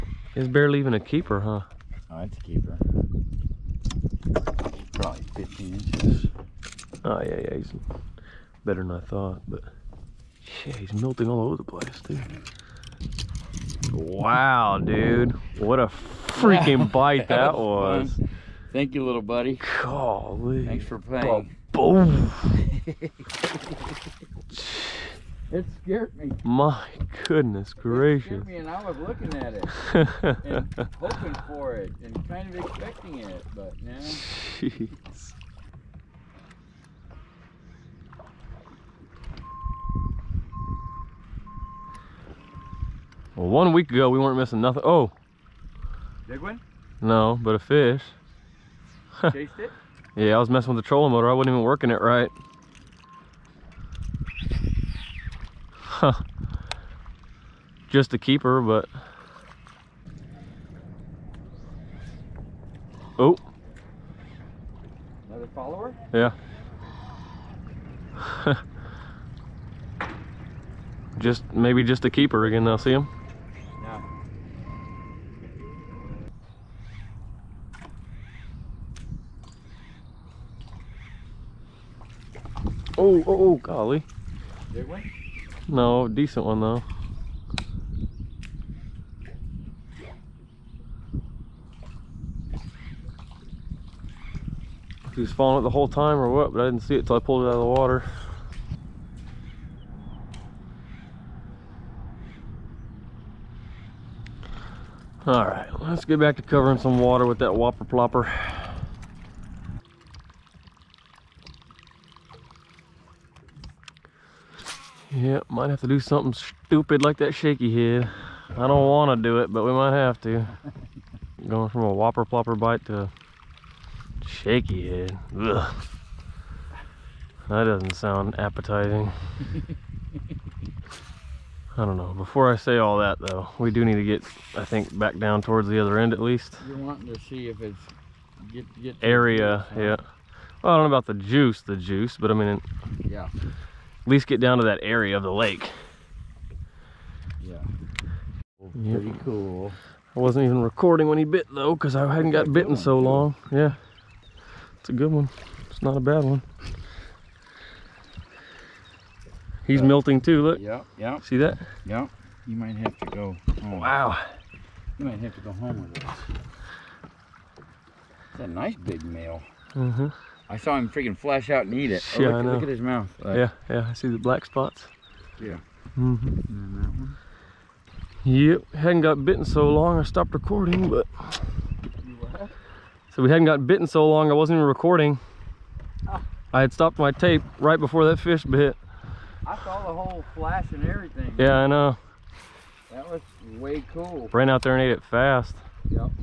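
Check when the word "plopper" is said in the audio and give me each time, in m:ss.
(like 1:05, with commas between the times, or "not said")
1:47, 2:02.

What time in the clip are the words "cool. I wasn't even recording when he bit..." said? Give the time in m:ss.
2:29.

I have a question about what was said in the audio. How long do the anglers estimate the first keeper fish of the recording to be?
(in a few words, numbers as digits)
15 inches.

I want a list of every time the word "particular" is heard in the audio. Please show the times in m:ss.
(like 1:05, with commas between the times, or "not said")
not said.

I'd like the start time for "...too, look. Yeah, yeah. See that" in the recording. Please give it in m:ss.
2:40.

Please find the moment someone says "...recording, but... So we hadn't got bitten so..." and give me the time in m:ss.
3:00.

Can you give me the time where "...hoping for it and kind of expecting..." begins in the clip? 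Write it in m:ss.
0:30.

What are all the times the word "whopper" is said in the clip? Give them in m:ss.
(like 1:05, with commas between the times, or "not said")
1:47, 2:01.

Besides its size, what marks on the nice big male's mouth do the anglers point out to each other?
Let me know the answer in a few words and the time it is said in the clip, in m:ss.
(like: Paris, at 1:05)
black spots, at 2:54.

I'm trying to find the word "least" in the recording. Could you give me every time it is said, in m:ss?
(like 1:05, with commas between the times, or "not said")
2:16, 2:24.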